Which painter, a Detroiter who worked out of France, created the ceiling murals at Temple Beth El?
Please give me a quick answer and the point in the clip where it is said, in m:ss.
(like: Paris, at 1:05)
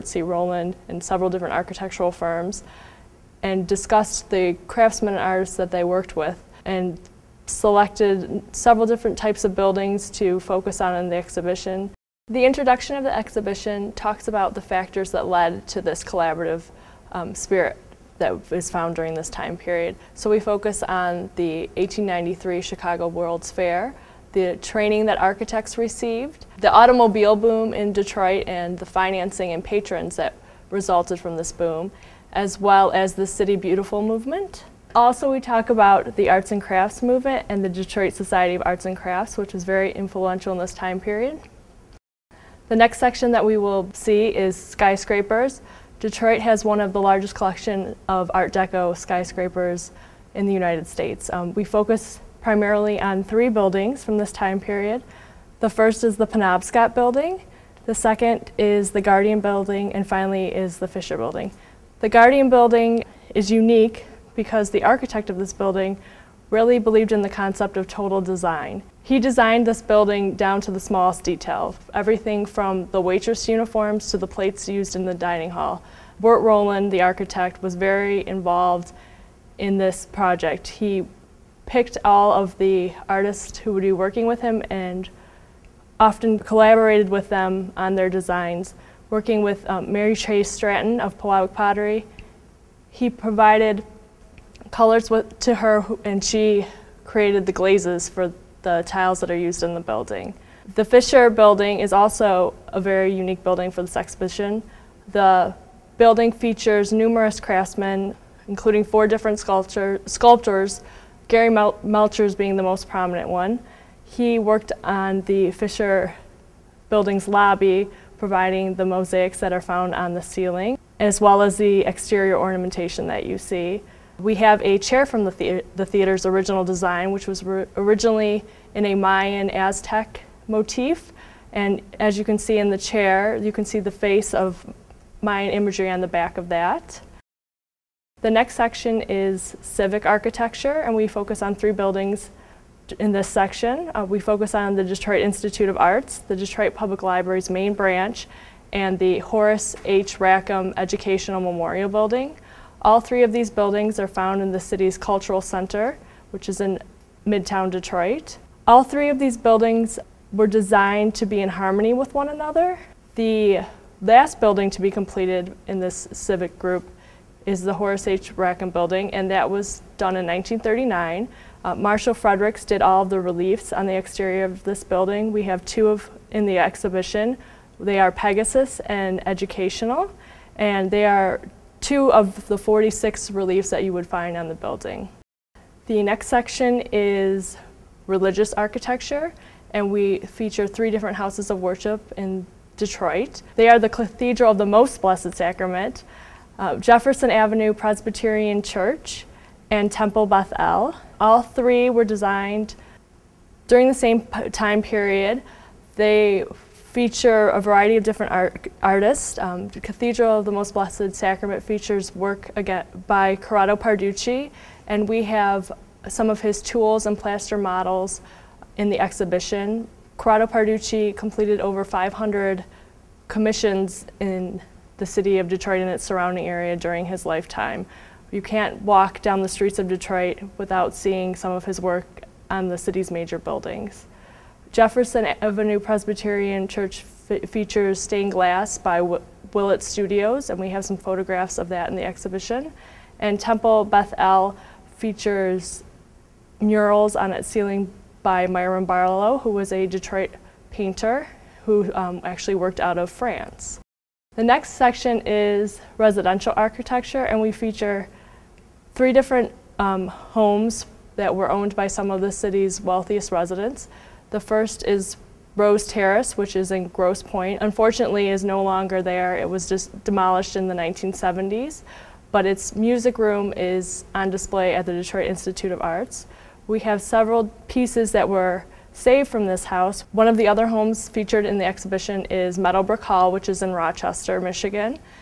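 Myron Barlow, at 4:08.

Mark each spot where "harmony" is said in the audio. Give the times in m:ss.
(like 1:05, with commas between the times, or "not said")
2:41.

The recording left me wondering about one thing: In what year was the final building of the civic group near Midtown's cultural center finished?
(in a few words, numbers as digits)
1939.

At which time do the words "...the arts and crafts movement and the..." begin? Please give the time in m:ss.
0:36.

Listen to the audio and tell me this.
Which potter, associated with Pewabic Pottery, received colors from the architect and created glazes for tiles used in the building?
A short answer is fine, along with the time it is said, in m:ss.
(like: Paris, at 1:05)
Mary Chase Stratton, at 1:29.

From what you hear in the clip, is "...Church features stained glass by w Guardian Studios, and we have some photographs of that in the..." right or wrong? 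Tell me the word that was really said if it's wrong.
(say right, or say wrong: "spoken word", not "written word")
wrong: "Willett", not "Guardian".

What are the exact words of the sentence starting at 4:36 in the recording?
We have several pieces that were saved from this house.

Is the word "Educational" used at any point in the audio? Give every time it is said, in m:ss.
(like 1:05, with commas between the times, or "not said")
2:30, 2:59.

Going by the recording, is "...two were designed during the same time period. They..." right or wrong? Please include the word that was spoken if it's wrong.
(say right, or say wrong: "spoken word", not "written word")
wrong: "three", not "two".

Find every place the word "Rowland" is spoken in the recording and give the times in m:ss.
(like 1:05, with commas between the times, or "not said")
0:00, 1:16.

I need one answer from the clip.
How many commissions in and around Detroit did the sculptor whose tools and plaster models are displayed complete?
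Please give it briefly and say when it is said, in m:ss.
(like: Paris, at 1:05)
500, at 3:41.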